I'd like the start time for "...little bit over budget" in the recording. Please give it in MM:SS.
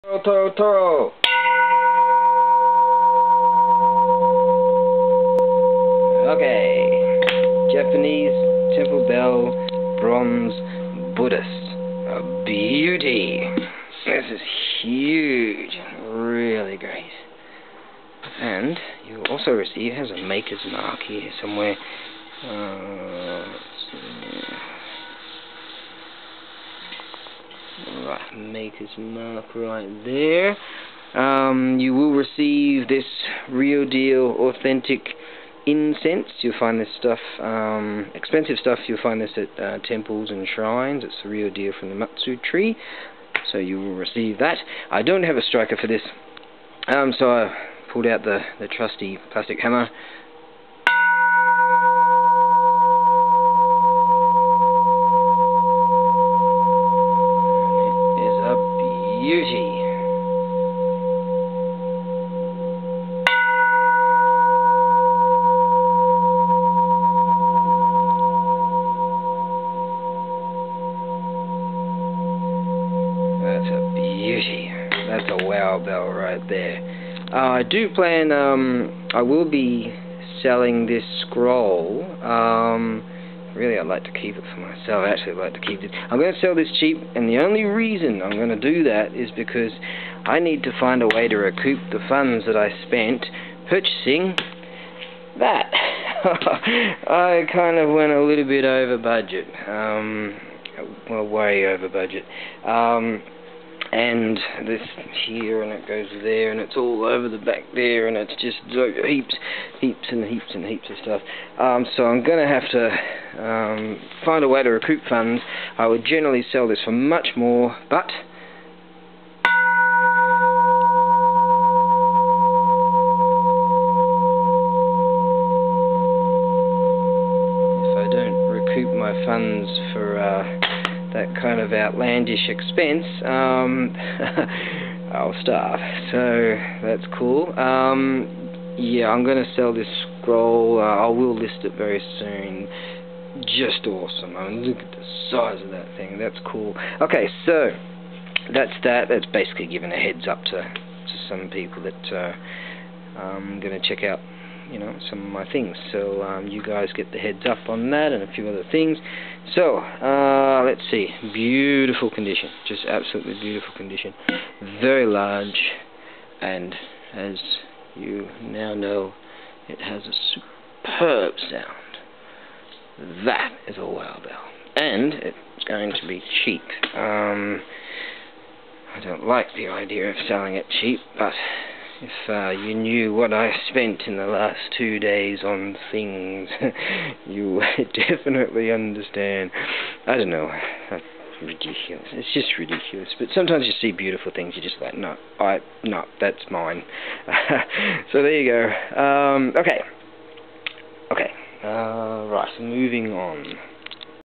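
01:38.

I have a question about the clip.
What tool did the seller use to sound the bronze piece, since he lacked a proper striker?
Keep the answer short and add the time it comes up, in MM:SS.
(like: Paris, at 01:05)
plastic hammer, at 00:49.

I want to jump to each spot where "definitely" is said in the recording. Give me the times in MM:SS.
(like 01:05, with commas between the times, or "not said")
03:08.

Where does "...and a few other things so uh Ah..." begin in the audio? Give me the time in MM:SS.
02:38.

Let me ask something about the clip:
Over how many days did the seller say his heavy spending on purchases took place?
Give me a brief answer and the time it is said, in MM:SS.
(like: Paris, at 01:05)
2, at 03:04.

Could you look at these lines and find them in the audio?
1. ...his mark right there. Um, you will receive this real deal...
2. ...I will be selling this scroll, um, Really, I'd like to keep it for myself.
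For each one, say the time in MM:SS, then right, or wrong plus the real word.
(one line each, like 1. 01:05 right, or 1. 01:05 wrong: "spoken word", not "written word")
1. 00:28 right
2. 01:19 right.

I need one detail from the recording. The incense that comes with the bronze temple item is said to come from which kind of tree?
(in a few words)
Matsu tree.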